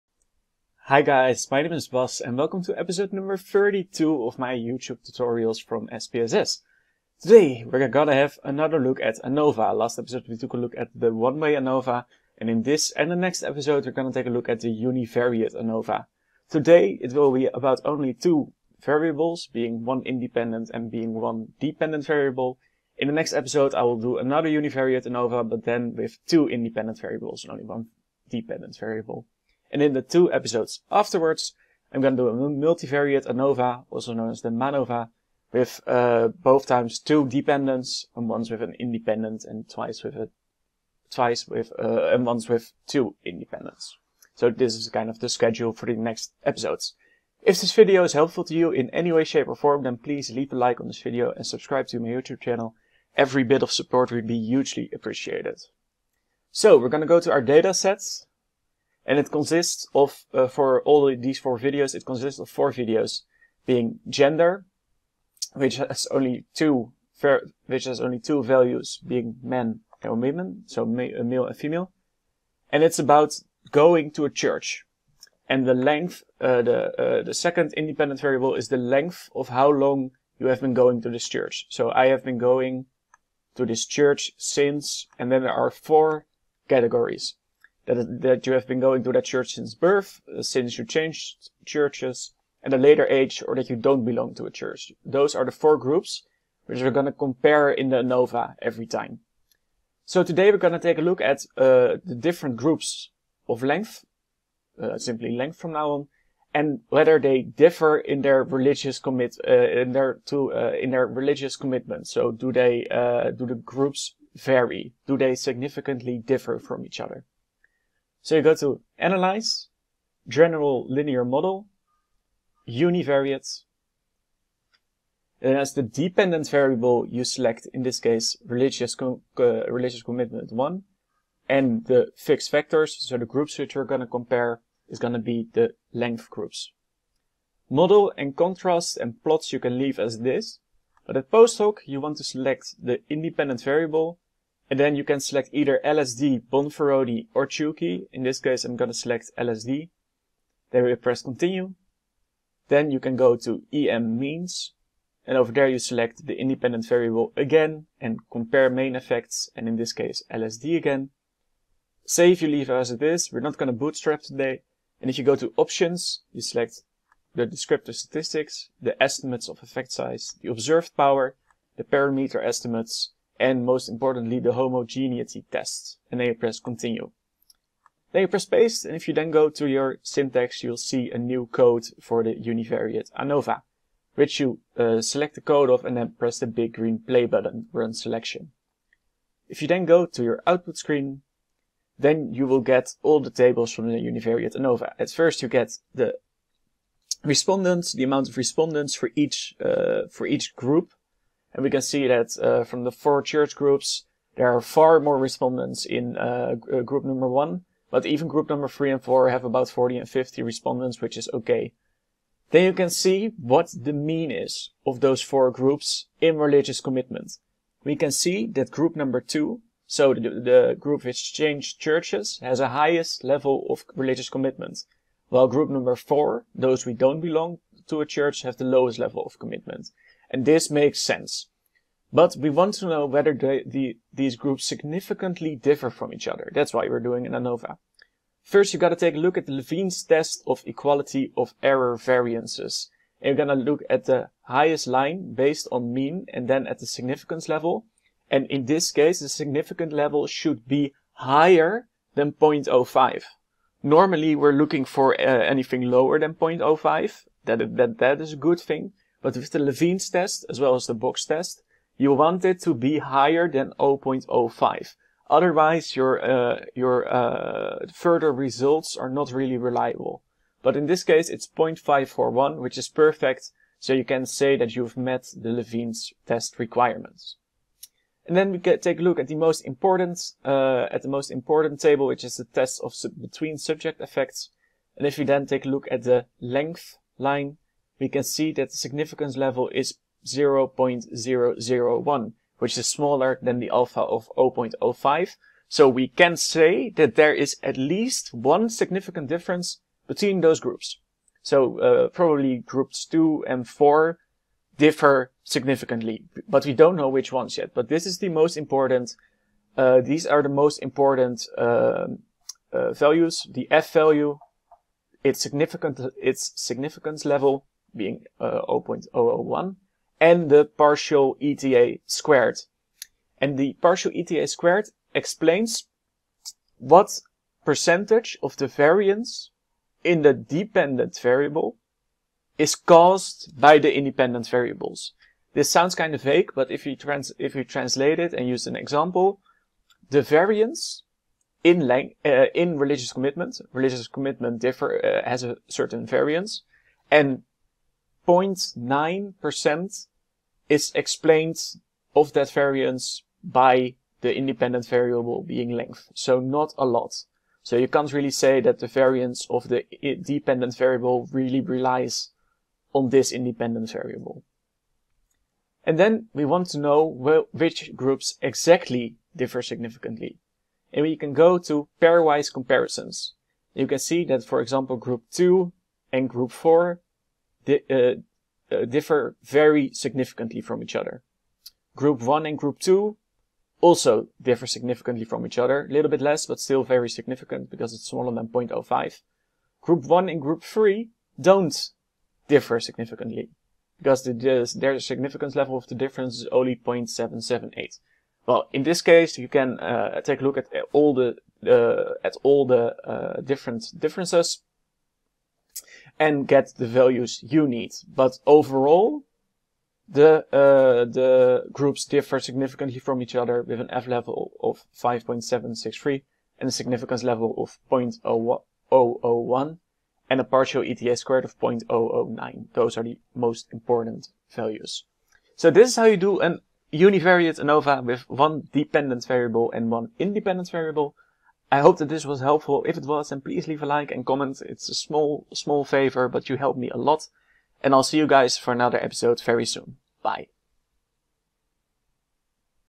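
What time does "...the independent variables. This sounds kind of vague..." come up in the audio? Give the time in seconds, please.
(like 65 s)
333 s.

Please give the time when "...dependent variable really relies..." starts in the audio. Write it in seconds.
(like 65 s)
360 s.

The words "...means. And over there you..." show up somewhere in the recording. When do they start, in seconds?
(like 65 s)
154 s.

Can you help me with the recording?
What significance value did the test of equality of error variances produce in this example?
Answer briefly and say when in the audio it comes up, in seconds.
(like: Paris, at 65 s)
0.541, at 271 s.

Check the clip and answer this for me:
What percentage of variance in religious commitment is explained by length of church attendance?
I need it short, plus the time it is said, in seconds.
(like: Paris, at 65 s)
0.9%, at 348 s.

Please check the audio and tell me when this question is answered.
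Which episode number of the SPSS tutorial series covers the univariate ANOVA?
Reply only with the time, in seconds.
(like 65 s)
2 s.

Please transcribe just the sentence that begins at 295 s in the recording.
So we can say that there is at least one significant difference between those groups.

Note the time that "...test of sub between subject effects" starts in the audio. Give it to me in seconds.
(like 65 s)
282 s.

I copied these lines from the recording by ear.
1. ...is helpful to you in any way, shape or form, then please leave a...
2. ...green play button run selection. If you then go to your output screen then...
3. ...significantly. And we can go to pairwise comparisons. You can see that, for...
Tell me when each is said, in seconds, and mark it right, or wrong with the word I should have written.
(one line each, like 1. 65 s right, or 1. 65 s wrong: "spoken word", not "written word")
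1. 48 s right
2. 186 s right
3. 369 s right.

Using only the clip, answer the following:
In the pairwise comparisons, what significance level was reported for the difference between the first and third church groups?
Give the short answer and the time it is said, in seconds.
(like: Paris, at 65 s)
0.778, at 396 s.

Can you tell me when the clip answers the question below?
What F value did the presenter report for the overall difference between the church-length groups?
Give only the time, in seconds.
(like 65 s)
414 s.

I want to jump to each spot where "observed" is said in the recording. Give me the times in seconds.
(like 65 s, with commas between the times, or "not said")
170 s.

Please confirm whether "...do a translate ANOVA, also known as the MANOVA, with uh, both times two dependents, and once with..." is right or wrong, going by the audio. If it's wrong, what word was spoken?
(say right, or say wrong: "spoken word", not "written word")
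wrong: "multivariate", not "translate".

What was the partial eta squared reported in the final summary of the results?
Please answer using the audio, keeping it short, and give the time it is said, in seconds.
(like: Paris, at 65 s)
0.009, at 421 s.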